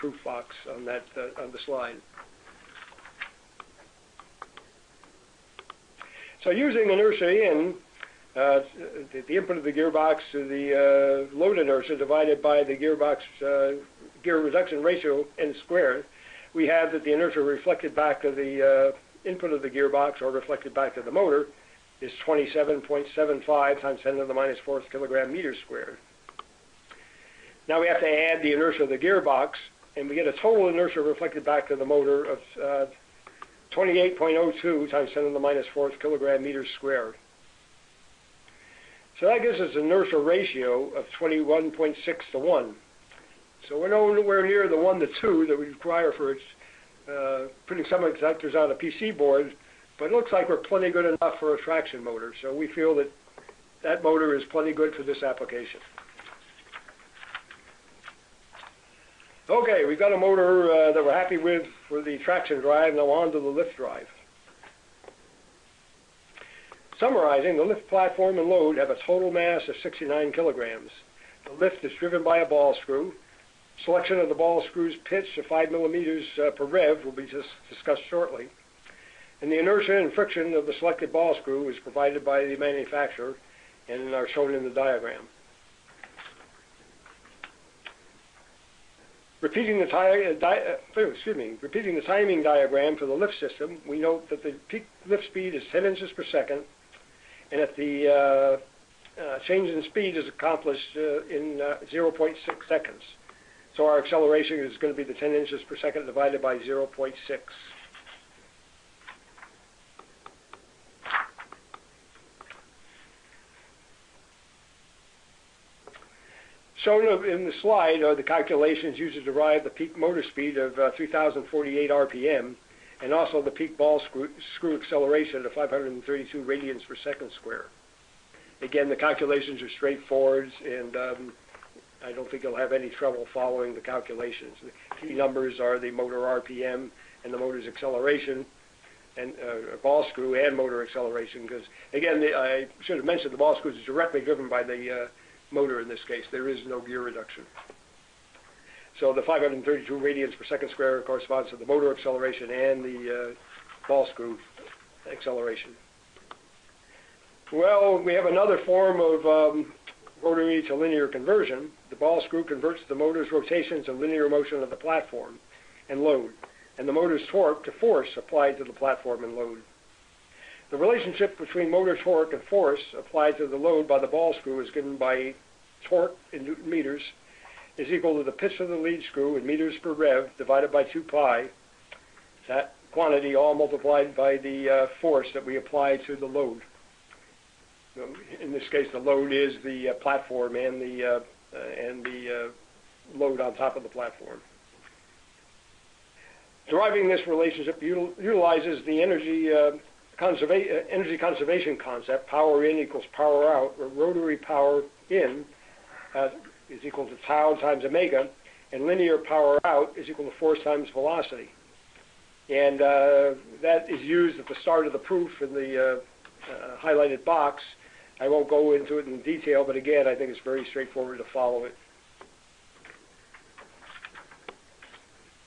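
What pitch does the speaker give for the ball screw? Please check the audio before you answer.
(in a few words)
5 millimeters per rev.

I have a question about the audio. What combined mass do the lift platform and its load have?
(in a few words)
69 kilograms.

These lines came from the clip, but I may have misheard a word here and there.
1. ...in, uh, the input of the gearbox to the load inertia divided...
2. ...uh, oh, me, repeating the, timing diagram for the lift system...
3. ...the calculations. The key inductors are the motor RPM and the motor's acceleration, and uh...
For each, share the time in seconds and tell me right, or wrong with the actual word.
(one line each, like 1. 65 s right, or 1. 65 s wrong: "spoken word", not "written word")
1. 7 s right
2. 90 s right
3. 133 s wrong: "numbers", not "inductors".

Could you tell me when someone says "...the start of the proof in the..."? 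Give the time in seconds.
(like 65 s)
214 s.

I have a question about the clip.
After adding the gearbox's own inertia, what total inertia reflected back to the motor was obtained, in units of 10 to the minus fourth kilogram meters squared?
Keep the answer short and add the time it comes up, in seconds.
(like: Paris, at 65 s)
28.02, at 33 s.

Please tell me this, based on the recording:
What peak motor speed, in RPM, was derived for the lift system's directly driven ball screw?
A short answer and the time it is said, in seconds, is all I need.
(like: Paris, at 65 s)
3,048 RPM, at 120 s.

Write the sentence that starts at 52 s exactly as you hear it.
so We feel that that motor is plenty good for this application.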